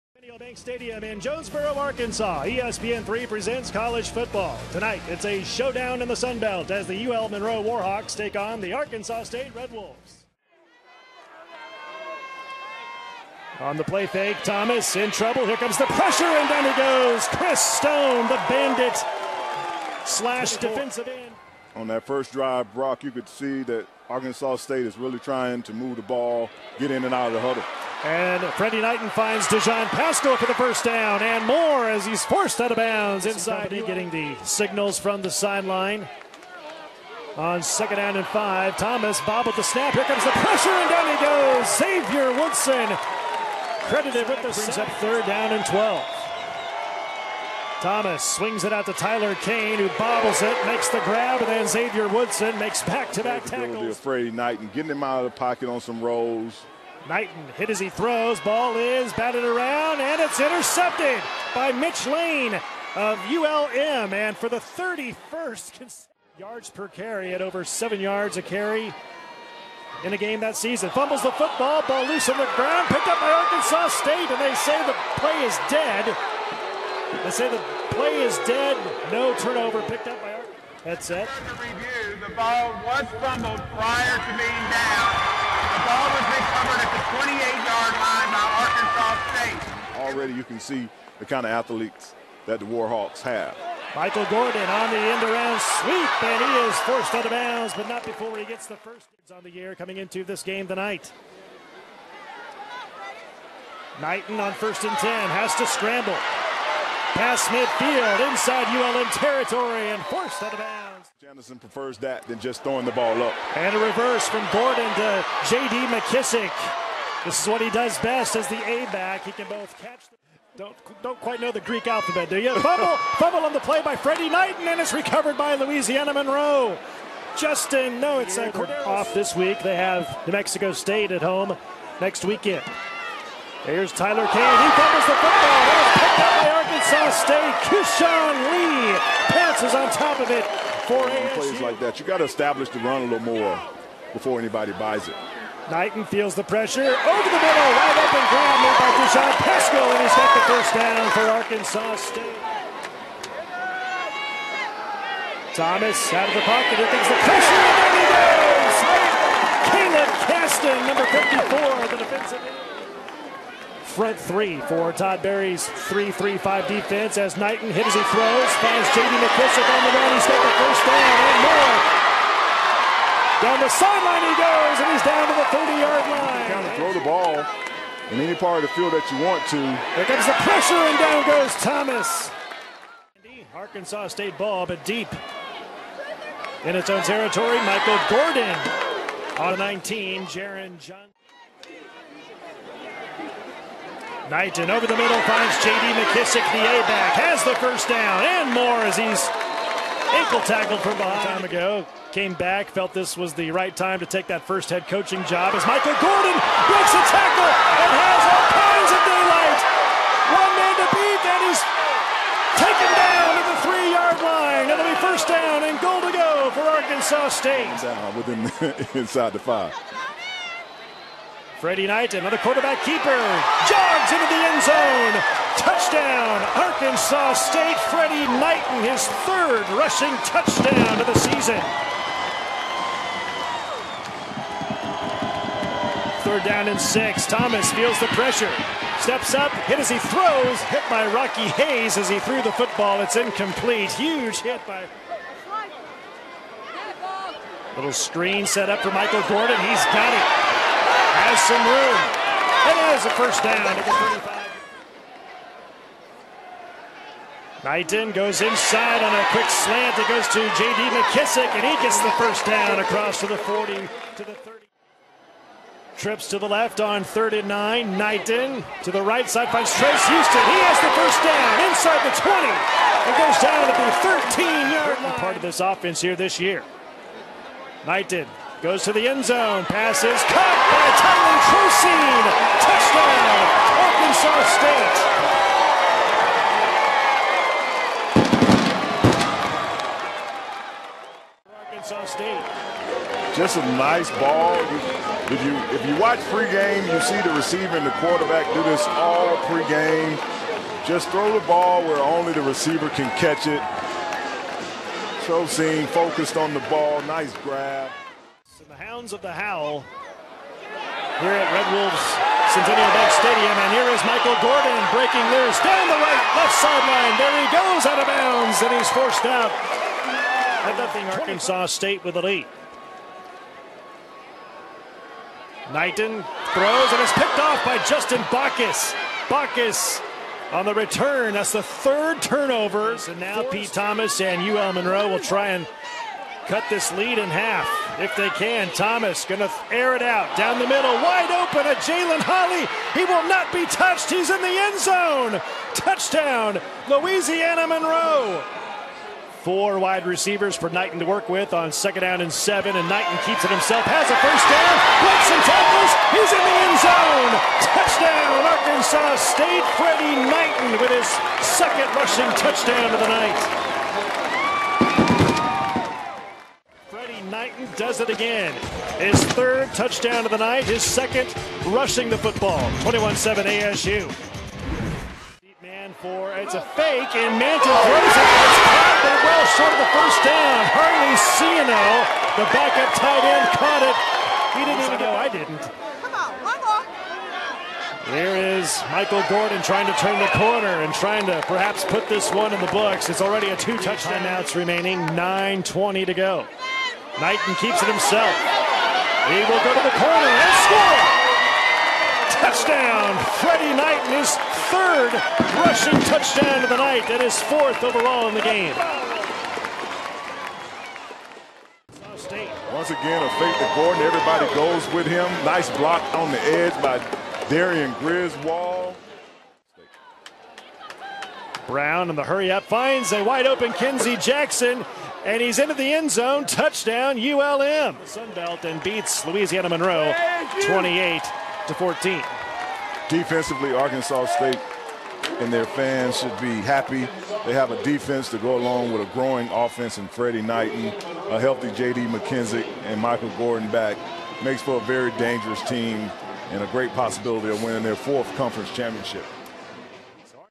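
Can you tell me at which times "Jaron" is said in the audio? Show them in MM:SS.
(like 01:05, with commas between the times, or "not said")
03:10.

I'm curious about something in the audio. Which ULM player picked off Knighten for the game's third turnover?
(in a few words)
Justin Bacchus.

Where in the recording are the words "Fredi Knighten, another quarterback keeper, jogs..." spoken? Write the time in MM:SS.
03:41.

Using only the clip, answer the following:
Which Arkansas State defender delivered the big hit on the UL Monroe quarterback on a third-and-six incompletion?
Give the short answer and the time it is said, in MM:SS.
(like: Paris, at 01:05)
Rocky Hayes, at 04:01.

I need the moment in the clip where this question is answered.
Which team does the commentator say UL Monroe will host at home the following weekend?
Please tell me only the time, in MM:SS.
02:10.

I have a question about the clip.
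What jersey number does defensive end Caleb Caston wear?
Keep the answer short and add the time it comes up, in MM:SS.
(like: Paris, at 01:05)
54, at 02:41.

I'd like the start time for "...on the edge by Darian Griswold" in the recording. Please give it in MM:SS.
06:56.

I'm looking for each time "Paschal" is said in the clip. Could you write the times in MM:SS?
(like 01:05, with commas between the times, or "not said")
00:29, 02:29.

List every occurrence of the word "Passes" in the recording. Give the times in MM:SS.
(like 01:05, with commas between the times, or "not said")
04:39.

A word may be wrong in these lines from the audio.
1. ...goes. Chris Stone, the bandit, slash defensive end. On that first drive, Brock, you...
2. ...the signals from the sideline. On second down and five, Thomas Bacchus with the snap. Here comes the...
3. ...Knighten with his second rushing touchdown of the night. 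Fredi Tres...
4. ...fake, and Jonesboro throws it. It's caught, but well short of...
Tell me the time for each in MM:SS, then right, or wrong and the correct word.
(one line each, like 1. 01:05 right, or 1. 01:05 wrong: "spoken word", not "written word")
1. 00:16 right
2. 00:34 wrong: "Bob", not "Bacchus"
3. 06:00 wrong: "Knighten", not "Tres"
4. 06:16 wrong: "Mantle", not "Jonesboro".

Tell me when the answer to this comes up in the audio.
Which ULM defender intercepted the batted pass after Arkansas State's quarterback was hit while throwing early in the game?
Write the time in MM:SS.
01:01.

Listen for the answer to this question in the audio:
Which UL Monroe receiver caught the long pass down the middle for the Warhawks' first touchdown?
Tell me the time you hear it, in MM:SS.
05:41.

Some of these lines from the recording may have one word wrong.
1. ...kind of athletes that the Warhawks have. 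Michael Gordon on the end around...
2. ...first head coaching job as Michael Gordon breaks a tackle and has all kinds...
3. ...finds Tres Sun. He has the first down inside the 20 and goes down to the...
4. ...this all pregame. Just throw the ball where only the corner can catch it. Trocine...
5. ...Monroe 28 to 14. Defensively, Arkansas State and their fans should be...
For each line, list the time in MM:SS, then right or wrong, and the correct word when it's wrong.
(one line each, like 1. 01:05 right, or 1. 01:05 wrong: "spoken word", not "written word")
1. 01:31 right
2. 03:24 right
3. 04:29 wrong: "Houston", not "Sun"
4. 04:58 wrong: "receiver", not "corner"
5. 07:09 right.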